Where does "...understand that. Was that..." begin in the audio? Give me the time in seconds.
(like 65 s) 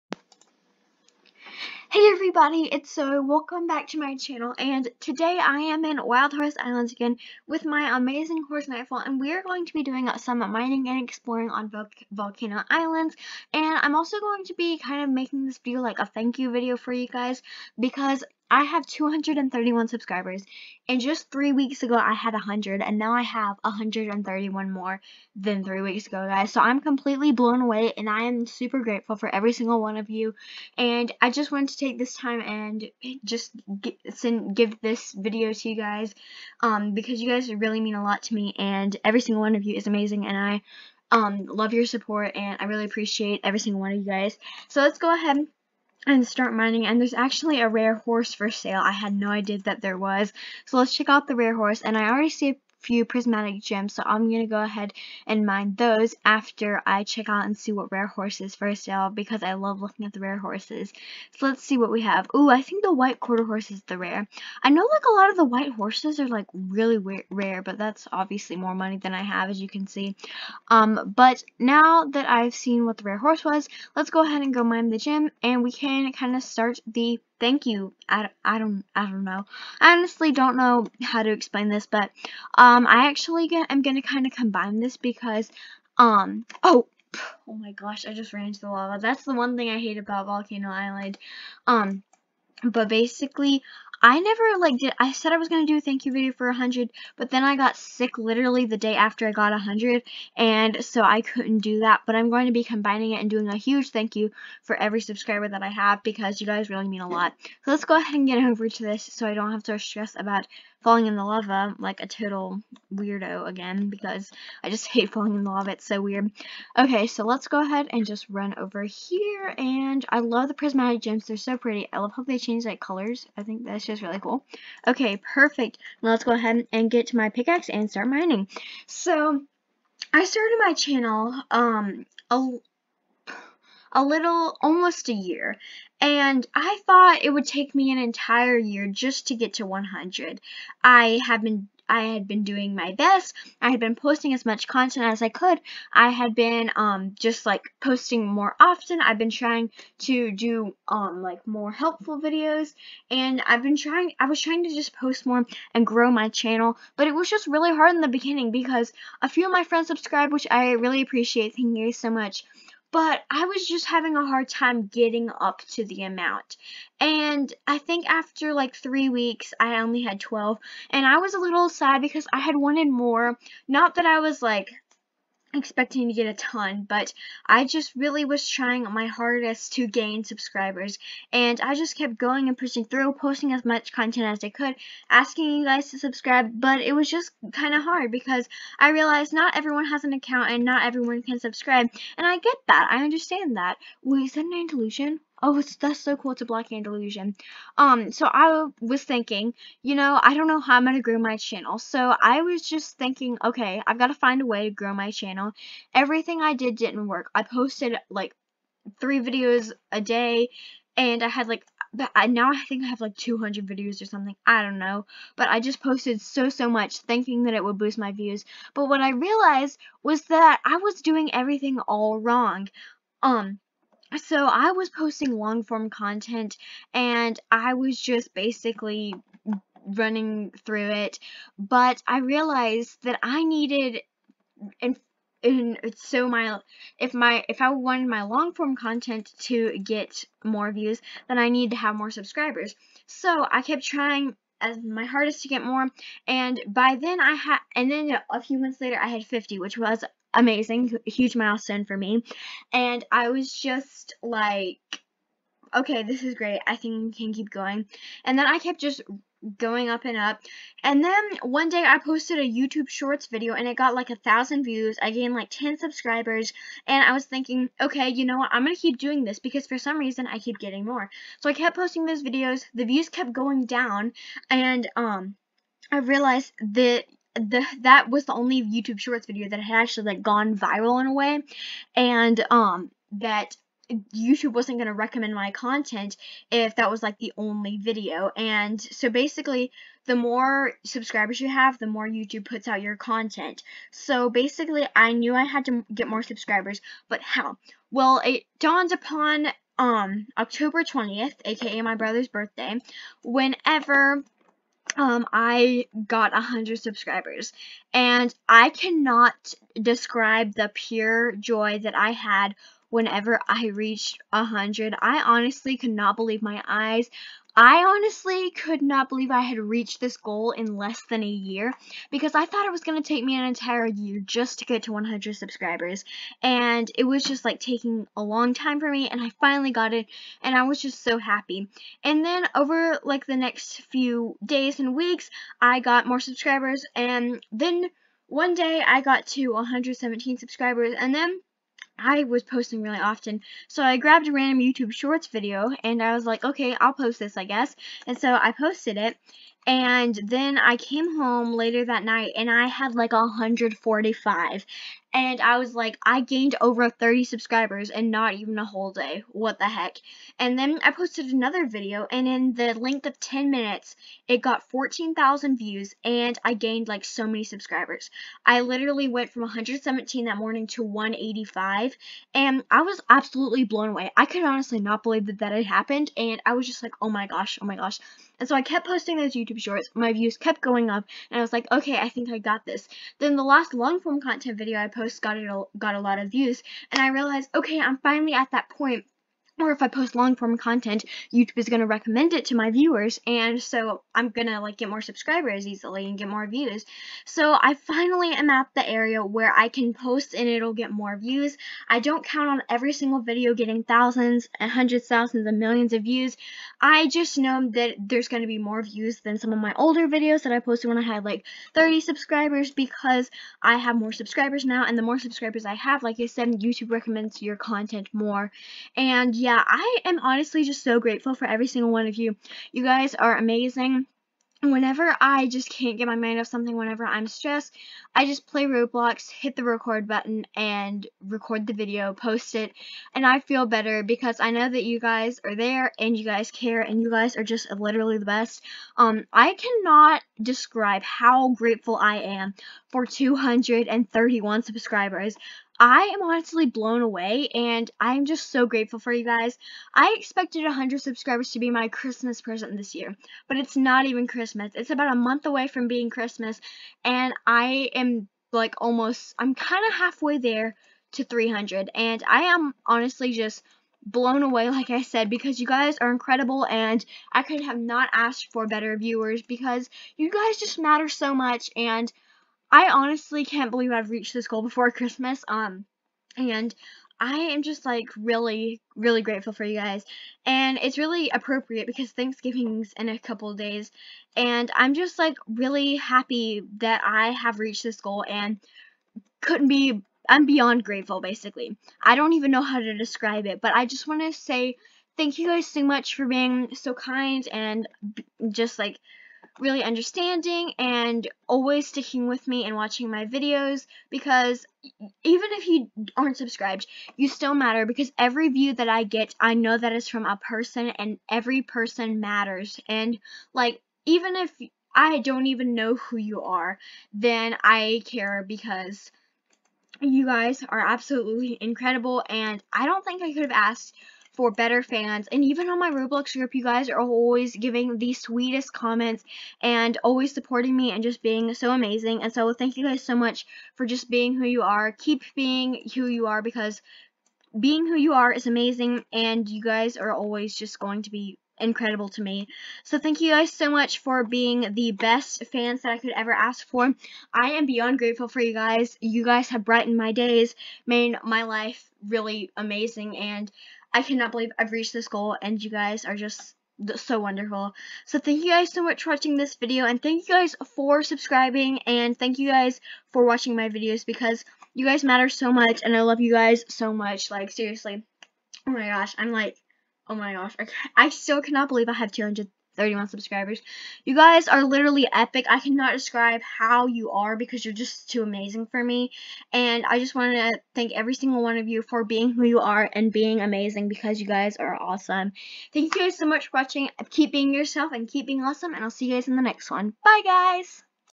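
193 s.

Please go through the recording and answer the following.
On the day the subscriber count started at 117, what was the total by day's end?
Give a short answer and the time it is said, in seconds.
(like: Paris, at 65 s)
185, at 370 s.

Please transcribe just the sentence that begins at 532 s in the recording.
And so thank you guys so much for just being who you are.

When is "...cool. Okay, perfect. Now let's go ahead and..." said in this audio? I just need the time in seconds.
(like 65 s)
124 s.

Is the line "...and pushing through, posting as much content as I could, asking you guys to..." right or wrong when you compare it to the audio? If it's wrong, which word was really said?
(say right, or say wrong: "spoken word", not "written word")
right.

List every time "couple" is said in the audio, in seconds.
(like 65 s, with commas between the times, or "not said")
483 s.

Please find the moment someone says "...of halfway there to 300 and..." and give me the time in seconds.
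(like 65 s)
459 s.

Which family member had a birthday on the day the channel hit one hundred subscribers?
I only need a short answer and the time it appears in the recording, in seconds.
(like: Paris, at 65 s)
brother's, at 301 s.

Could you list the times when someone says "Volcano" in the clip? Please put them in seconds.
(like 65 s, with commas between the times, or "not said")
12 s, 90 s.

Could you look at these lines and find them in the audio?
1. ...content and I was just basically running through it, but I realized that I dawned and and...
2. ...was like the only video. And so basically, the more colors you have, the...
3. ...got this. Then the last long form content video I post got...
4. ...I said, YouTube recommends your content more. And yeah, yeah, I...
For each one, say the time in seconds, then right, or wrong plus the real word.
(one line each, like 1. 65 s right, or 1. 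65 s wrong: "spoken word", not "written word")
1. 225 s wrong: "needed", not "dawned"
2. 286 s wrong: "subscribers", not "colors"
3. 382 s right
4. 416 s right.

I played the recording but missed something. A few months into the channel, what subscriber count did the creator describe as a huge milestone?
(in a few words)
50.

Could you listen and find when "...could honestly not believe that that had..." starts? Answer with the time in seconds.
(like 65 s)
374 s.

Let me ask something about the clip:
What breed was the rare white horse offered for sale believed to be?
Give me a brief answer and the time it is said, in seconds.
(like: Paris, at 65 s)
quarter horse, at 63 s.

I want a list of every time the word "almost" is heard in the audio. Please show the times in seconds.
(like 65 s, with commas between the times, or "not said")
134 s, 458 s.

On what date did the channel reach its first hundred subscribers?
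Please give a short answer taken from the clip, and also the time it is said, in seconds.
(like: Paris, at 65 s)
October 20th, at 300 s.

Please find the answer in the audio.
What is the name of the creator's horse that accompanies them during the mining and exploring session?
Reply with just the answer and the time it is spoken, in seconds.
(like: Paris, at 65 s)
Nightfall, at 8 s.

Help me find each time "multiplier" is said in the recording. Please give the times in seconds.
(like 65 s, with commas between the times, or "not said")
not said.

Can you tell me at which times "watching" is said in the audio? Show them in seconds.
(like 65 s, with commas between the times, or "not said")
502 s, 559 s, 563 s, 586 s.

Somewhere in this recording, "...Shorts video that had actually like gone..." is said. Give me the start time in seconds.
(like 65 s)
278 s.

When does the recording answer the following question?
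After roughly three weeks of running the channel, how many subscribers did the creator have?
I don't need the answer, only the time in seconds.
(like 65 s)
170 s.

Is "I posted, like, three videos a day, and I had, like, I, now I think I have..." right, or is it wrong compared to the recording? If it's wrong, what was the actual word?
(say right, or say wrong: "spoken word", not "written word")
right.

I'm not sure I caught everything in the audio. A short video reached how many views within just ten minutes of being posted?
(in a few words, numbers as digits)
14,000.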